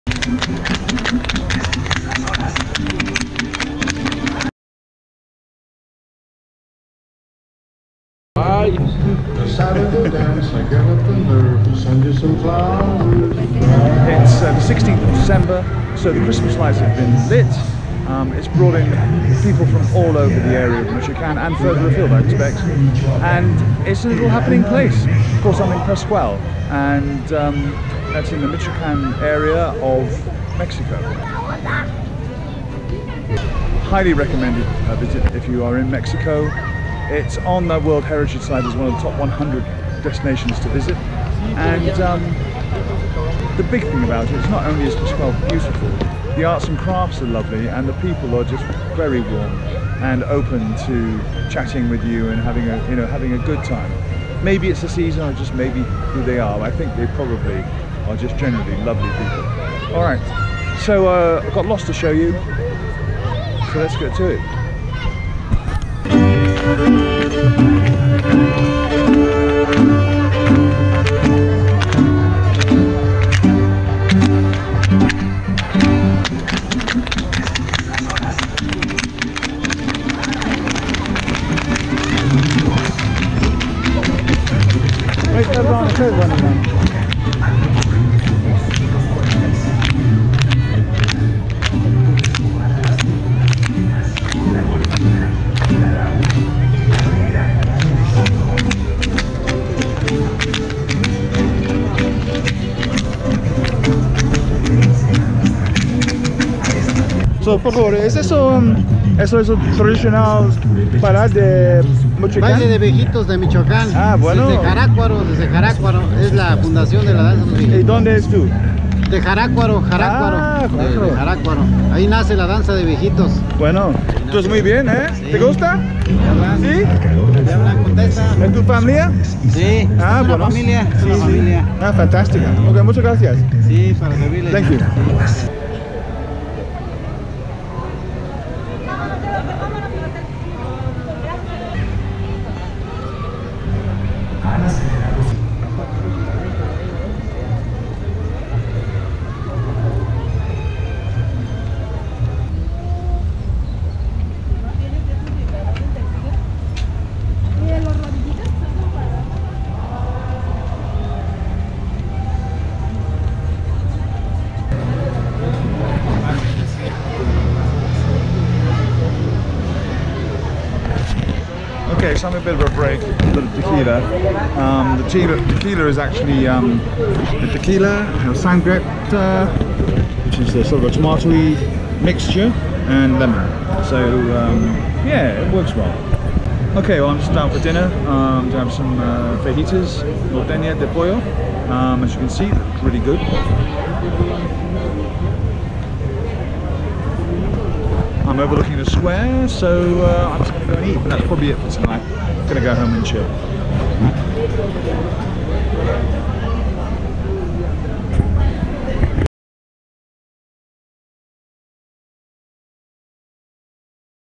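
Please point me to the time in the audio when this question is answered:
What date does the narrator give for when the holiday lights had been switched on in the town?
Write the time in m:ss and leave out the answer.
0:14.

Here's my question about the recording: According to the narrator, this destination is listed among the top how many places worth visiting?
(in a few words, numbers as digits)
100.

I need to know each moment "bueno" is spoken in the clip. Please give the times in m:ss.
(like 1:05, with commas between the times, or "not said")
1:54, 2:03.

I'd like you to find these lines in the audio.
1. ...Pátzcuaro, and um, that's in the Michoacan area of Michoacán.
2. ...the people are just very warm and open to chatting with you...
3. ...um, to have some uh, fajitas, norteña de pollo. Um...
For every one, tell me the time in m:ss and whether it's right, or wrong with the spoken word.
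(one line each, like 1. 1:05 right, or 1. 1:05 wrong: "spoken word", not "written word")
1. 0:25 wrong: "Mexico", not "Michoacán"
2. 0:47 right
3. 3:08 right.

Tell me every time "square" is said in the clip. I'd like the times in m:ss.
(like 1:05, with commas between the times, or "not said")
3:18.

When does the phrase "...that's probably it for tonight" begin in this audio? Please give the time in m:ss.
3:21.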